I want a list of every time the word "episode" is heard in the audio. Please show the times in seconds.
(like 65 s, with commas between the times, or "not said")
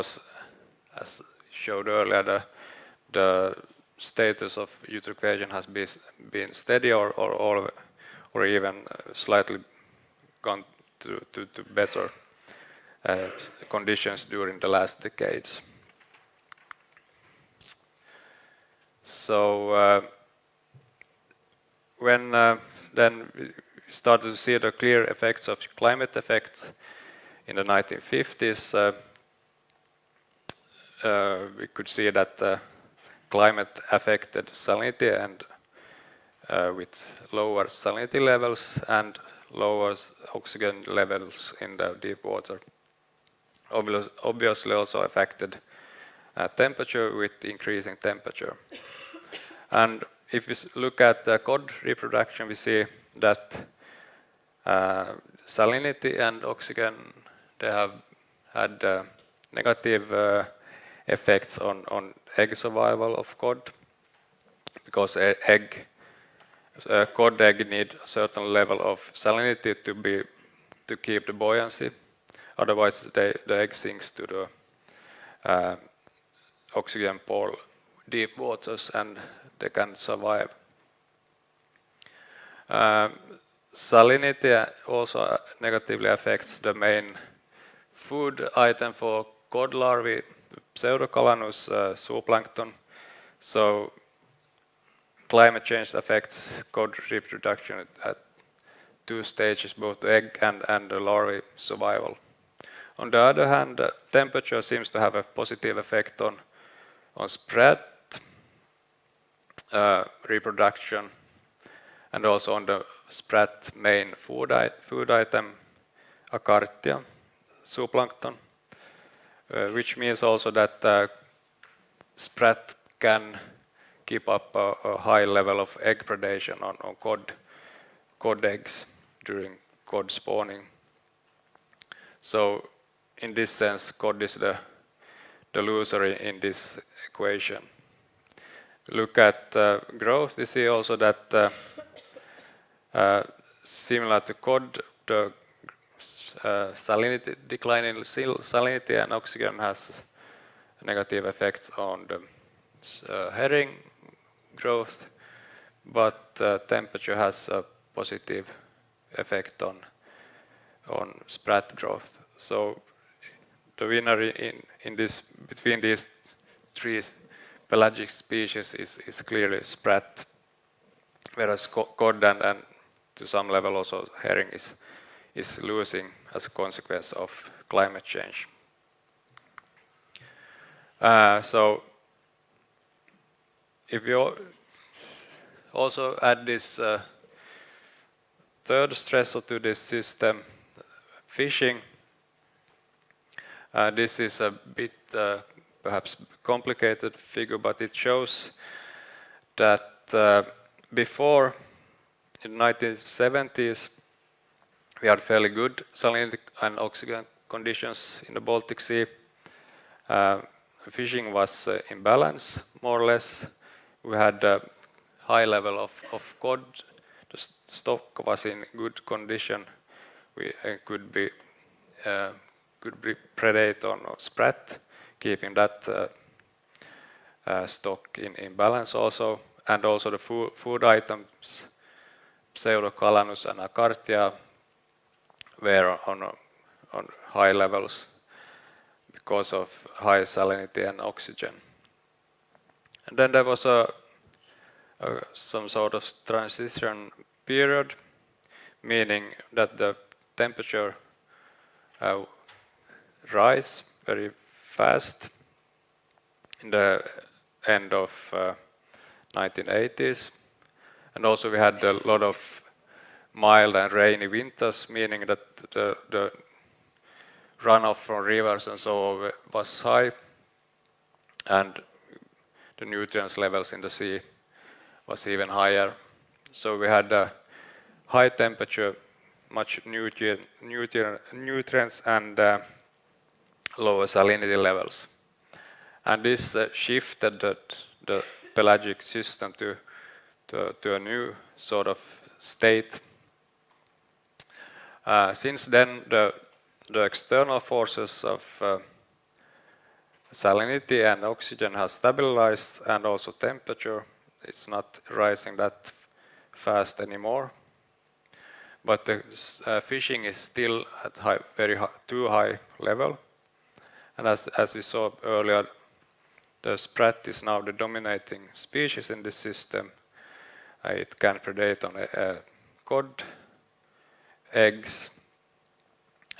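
not said.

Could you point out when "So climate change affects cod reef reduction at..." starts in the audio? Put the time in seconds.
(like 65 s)
93 s.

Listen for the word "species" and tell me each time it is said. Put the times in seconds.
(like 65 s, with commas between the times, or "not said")
168 s, 318 s.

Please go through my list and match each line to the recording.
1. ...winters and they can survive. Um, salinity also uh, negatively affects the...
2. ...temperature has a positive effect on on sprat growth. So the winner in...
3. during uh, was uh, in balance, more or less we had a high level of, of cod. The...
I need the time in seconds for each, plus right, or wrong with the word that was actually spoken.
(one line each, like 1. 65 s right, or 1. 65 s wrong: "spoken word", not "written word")
1. 78 s wrong: "waters", not "winters"
2. 156 s right
3. 210 s wrong: "fishing", not "during".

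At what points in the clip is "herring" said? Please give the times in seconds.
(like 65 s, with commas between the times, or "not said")
153 s, 174 s.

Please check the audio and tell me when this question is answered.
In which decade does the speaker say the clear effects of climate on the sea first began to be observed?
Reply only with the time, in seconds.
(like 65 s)
27 s.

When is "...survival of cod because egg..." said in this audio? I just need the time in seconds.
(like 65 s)
62 s.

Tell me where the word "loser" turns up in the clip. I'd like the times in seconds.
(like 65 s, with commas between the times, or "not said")
135 s.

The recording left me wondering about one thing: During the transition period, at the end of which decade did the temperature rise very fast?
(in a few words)
1980s.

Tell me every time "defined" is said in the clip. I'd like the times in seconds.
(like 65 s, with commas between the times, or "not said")
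not said.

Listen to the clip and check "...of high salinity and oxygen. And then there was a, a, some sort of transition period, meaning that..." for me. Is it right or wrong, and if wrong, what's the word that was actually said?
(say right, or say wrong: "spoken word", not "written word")
right.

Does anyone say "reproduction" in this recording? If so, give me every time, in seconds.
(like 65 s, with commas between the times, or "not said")
51 s, 110 s.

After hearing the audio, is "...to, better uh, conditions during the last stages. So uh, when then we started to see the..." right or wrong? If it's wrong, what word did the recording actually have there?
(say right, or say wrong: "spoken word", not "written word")
wrong: "decades", not "stages".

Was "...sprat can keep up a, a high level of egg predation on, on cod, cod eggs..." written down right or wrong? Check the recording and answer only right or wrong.
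right.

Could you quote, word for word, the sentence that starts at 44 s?
Obviously also affected uh, temperature with increasing temperature.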